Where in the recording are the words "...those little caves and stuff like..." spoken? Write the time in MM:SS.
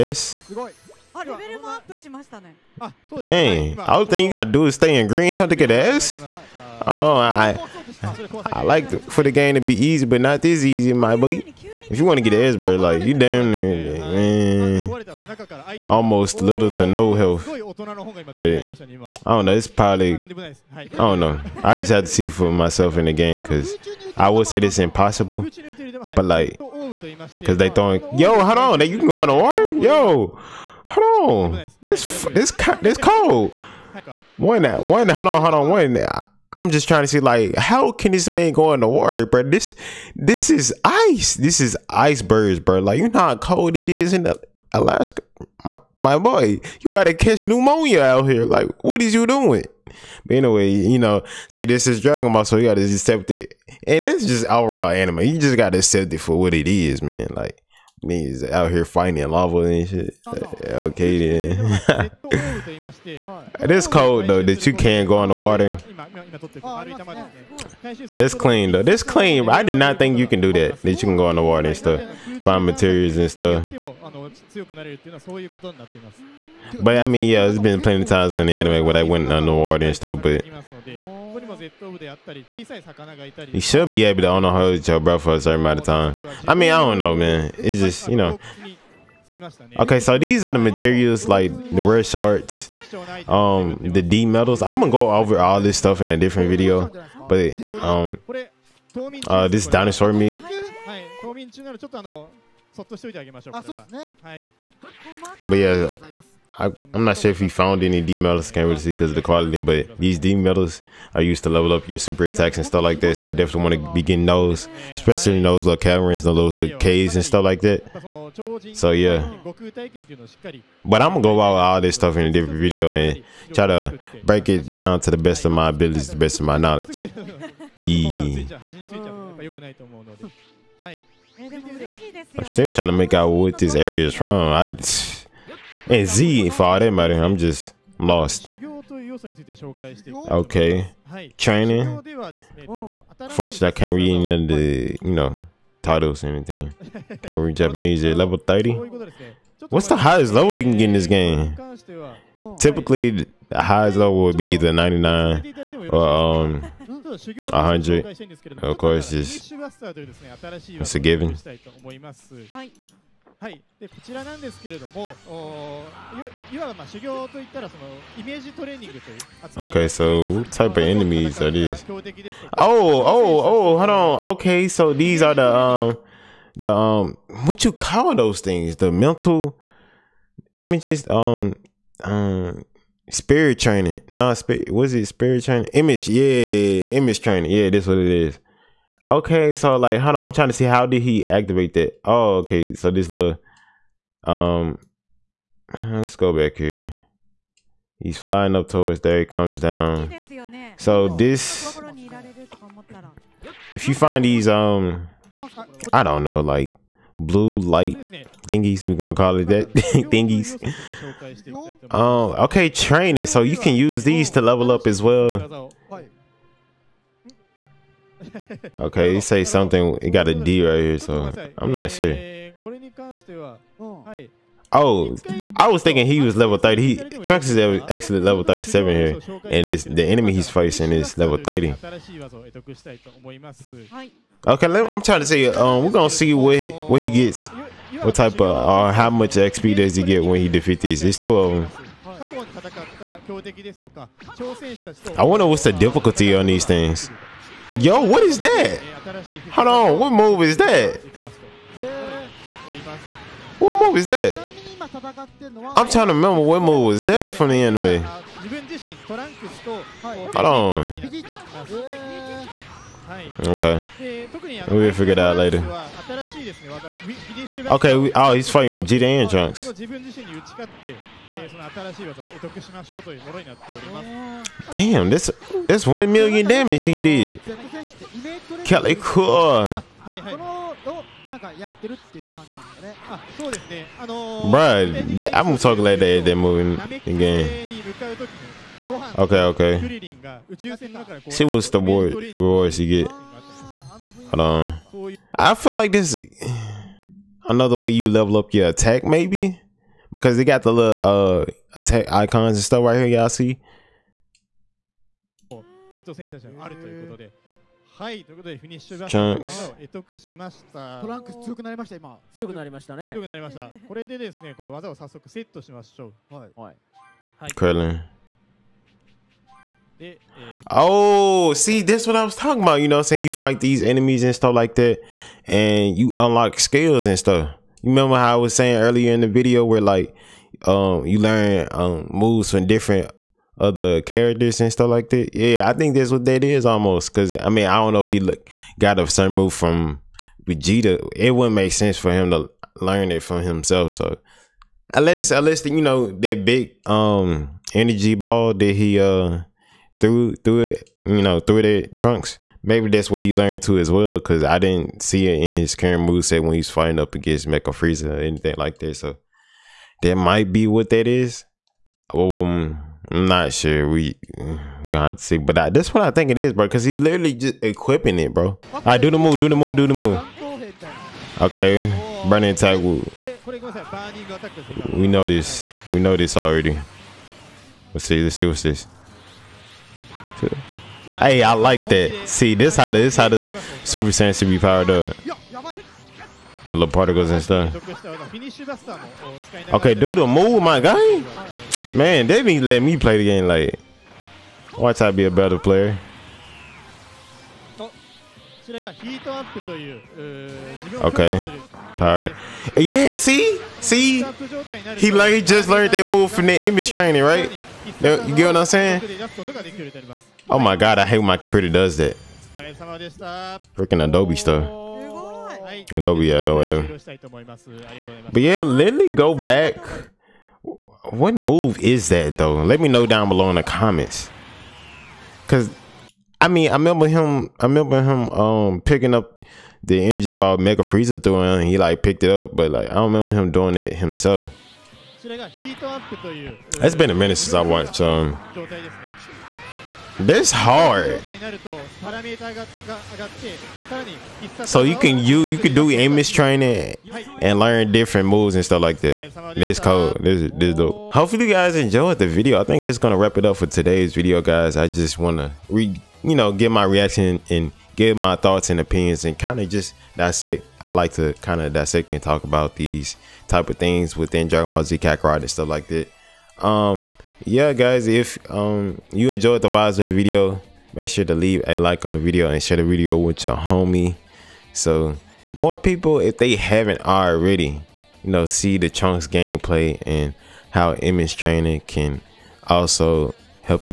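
01:56.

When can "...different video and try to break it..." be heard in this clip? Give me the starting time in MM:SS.
02:02.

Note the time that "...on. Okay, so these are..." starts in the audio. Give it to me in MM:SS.
02:53.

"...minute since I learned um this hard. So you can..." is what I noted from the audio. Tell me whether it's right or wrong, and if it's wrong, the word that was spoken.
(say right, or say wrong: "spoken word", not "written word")
wrong: "watched", not "learned".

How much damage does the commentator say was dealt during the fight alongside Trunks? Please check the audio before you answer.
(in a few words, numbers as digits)
1 million.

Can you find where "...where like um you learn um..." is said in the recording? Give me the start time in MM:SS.
05:29.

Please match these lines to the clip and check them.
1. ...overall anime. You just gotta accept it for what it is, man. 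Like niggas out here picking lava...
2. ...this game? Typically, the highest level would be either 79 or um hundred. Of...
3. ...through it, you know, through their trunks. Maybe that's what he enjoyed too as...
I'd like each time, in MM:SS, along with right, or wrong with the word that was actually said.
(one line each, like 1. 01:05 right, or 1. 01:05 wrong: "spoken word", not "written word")
1. 00:54 wrong: "fighting", not "picking"
2. 02:30 wrong: "99", not "79"
3. 05:50 wrong: "learned", not "enjoyed".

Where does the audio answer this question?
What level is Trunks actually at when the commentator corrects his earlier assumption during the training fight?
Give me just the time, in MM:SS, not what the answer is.
03:48.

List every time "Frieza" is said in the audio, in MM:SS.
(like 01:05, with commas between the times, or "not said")
05:57, 07:10.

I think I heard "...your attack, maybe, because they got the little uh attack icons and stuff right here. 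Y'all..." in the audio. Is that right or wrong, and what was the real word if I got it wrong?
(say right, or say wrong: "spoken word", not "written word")
right.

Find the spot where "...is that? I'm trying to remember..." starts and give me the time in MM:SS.
04:13.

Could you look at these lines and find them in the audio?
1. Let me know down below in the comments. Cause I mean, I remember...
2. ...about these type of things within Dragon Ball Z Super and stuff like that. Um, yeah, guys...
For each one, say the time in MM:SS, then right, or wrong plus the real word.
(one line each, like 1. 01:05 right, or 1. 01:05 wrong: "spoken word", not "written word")
1. 07:02 right
2. 07:42 wrong: "Kakarot", not "Super".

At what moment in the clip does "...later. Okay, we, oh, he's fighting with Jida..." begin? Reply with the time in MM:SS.
04:25.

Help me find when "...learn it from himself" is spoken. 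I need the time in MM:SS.
05:42.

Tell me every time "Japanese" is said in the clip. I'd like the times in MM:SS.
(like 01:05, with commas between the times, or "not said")
02:27.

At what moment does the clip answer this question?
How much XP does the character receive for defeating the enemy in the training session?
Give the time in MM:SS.
04:01.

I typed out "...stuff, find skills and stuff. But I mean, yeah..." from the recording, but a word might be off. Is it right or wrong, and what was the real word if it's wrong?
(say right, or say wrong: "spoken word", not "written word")
wrong: "materials", not "skills".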